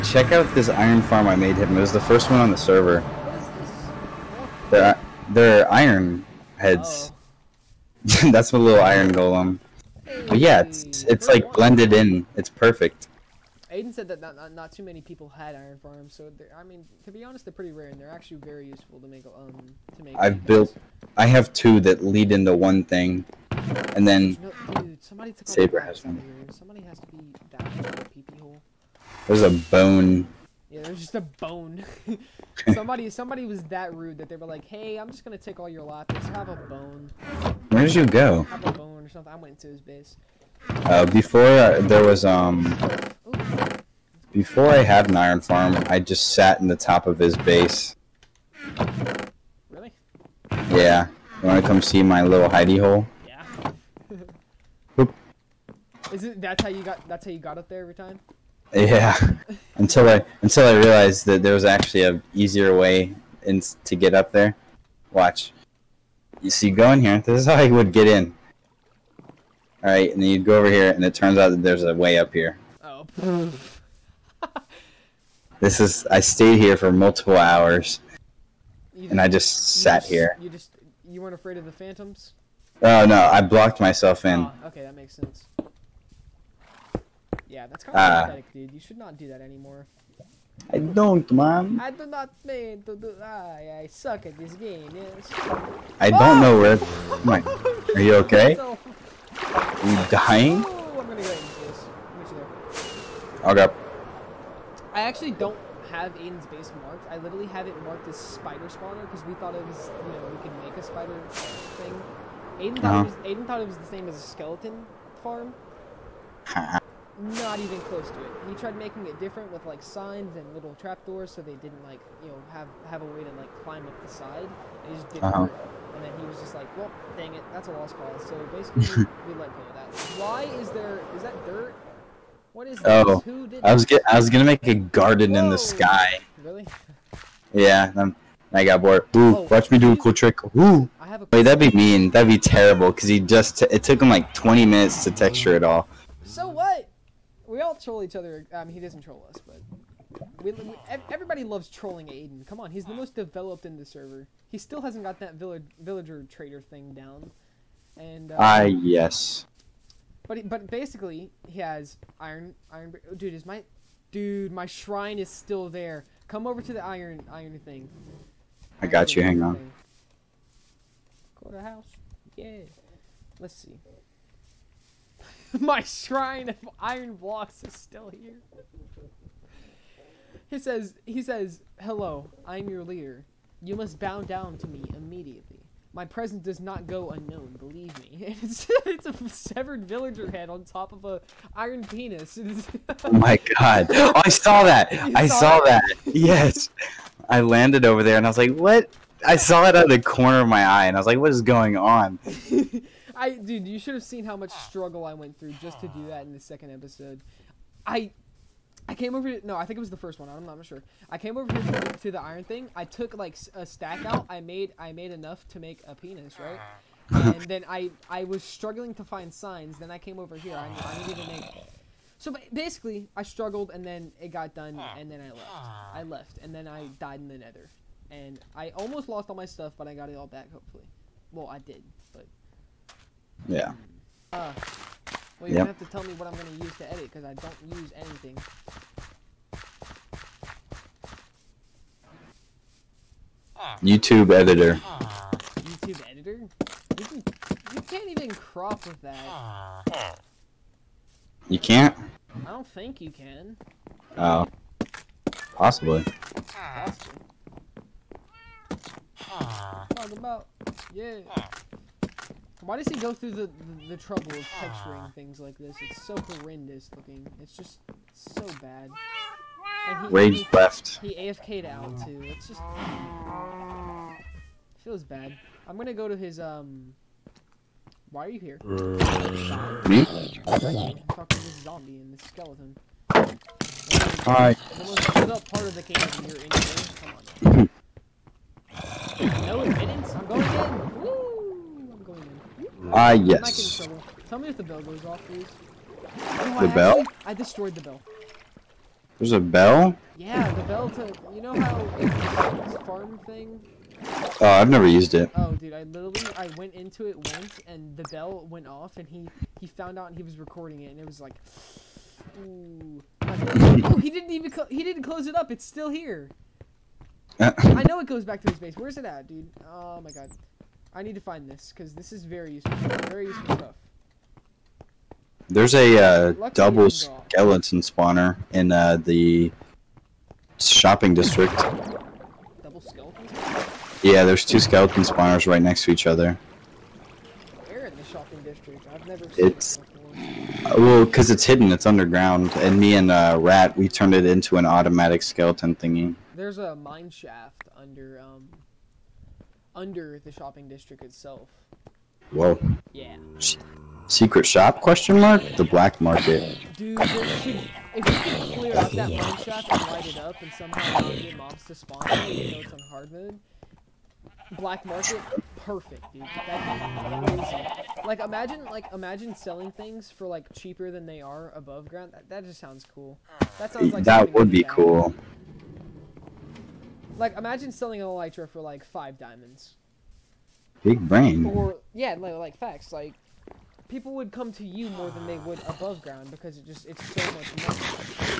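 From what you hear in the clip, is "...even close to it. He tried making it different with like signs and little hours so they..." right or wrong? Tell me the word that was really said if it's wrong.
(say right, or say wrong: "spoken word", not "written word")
wrong: "trapdoors", not "hours".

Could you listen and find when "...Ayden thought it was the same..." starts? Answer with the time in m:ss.
1:53.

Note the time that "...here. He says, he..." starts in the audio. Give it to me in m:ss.
2:58.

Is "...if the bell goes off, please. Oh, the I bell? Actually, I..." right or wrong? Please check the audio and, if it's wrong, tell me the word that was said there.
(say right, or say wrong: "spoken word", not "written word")
right.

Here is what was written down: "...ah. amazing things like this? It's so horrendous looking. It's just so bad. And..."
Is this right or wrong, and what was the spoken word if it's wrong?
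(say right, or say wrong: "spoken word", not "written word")
wrong: "texturing", not "amazing".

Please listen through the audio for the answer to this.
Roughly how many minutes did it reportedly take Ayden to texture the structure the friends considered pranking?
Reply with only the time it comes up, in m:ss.
2:24.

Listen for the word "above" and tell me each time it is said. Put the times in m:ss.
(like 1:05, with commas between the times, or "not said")
6:11, 6:25.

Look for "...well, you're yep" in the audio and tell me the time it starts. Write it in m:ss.
3:55.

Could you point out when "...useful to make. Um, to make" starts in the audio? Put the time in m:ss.
0:18.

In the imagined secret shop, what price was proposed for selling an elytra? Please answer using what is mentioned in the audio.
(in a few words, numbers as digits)
5 diamonds.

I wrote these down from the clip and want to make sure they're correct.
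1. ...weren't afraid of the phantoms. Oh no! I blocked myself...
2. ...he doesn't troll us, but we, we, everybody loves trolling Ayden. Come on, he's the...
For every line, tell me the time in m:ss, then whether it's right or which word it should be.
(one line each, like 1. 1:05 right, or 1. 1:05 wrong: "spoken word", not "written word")
1. 1:21 right
2. 2:28 right.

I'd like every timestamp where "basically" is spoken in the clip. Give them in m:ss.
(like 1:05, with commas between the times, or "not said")
2:08, 2:40, 3:42.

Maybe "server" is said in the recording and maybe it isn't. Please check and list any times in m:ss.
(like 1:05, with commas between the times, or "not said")
0:02, 2:33.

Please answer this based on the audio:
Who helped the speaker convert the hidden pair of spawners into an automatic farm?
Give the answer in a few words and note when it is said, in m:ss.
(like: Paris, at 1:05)
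Rat, at 5:43.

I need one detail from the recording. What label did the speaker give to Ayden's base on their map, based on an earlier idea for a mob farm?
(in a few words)
spider spawner.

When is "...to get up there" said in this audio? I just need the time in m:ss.
1:03.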